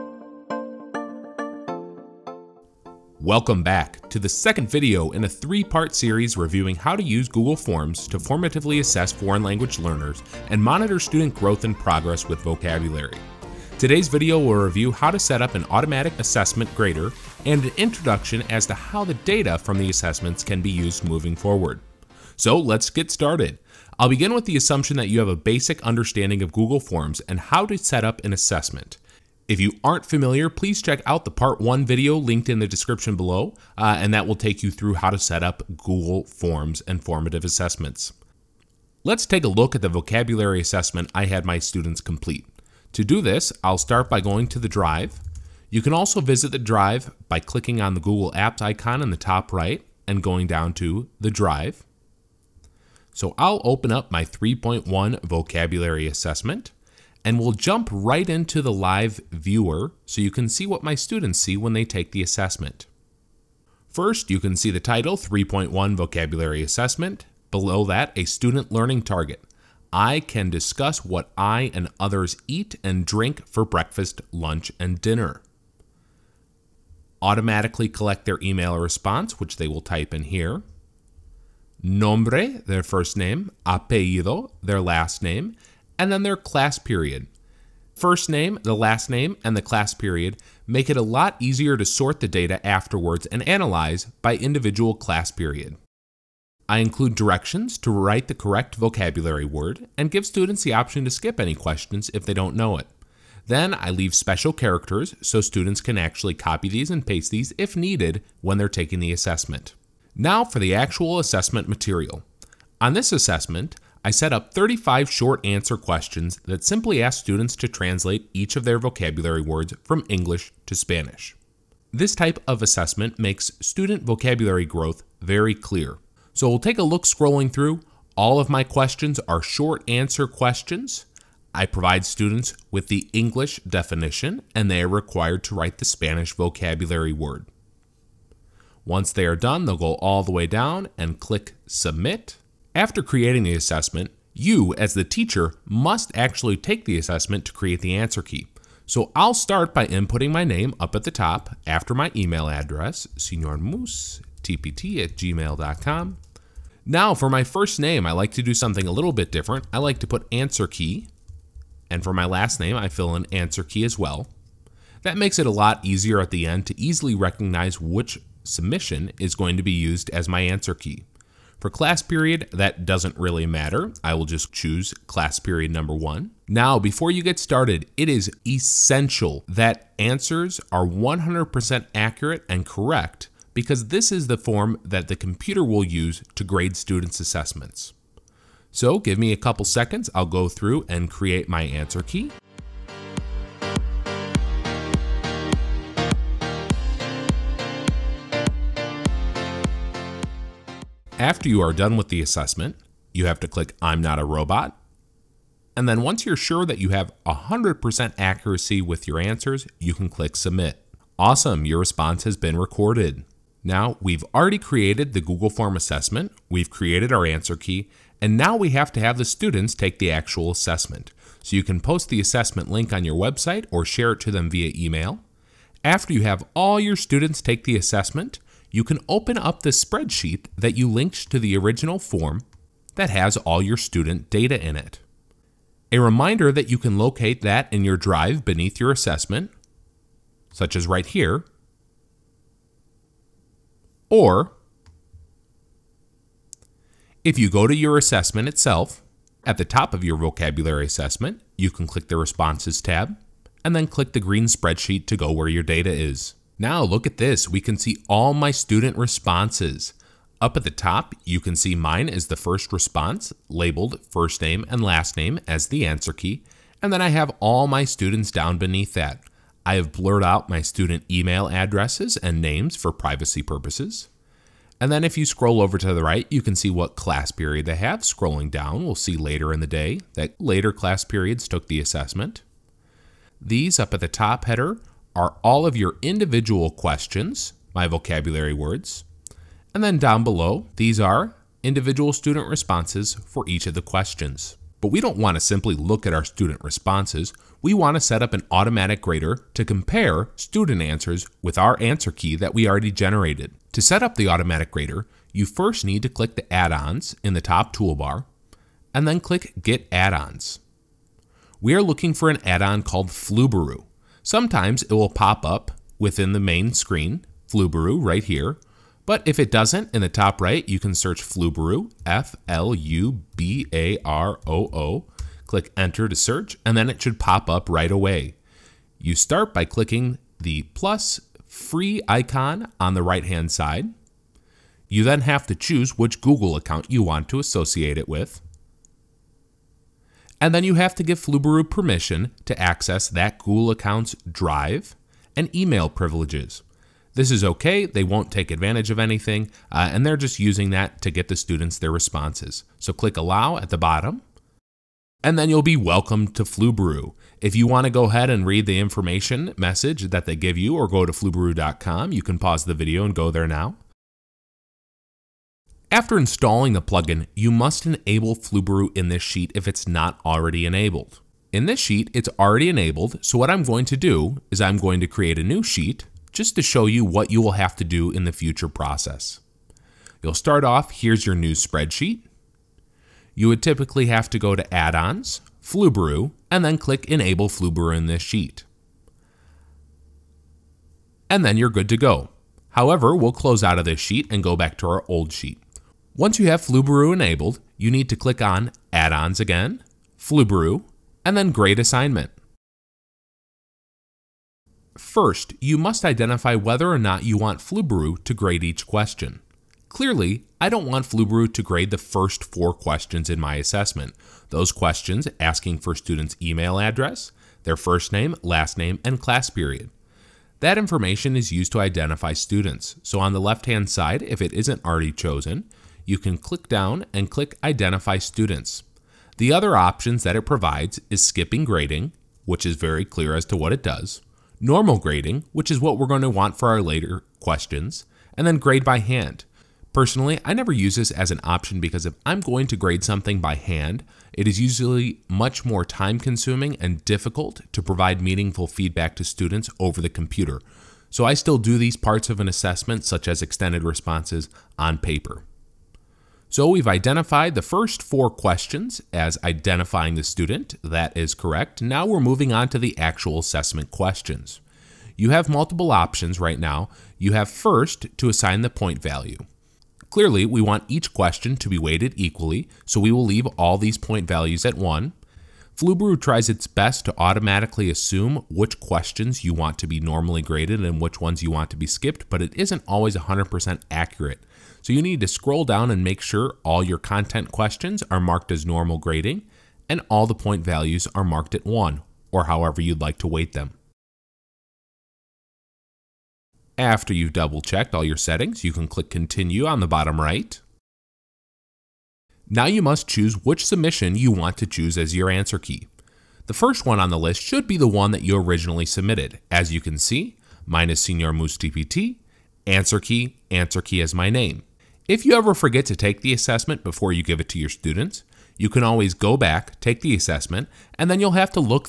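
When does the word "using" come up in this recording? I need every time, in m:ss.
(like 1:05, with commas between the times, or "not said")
5:50.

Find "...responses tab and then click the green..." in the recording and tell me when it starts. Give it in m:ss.
4:12.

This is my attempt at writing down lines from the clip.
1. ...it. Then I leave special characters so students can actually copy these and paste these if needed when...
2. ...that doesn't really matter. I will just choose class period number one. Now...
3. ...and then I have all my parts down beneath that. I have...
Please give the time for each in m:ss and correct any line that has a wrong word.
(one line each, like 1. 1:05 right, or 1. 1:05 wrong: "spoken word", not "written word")
1. 1:42 right
2. 2:52 right
3. 4:26 wrong: "students", not "parts".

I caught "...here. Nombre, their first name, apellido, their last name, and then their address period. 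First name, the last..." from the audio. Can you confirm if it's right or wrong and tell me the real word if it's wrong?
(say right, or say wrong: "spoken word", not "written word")
wrong: "class", not "address".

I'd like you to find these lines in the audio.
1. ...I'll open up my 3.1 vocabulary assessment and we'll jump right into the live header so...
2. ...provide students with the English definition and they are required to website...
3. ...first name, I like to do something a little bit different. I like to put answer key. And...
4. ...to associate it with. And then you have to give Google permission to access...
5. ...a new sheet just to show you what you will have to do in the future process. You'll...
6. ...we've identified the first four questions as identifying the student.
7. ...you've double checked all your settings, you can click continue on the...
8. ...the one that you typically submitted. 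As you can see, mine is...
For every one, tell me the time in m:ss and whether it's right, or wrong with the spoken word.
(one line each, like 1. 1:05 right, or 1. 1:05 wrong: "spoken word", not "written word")
1. 0:53 wrong: "viewer", not "header"
2. 2:11 wrong: "write", not "website"
3. 2:37 right
4. 5:37 wrong: "Flubaroo", not "Google"
5. 6:15 right
6. 7:36 right
7. 8:17 right
8. 8:27 wrong: "originally", not "typically".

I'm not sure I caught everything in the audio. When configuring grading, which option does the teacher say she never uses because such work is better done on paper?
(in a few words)
grade by hand.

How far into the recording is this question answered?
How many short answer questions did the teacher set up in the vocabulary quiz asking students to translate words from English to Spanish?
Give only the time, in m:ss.
1:54.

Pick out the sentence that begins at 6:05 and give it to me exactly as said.
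After installing the plugin, you must enable Flubaroo in this sheet if it's not already enabled.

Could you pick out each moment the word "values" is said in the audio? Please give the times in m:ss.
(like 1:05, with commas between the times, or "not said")
7:49, 7:54, 8:10.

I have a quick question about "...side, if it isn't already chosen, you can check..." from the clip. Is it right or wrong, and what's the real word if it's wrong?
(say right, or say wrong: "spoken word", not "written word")
wrong: "click", not "check".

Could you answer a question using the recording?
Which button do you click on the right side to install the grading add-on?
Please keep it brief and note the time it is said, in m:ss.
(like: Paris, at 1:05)
plus free, at 5:30.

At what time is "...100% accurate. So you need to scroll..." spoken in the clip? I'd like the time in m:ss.
8:03.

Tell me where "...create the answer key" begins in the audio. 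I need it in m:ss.
2:27.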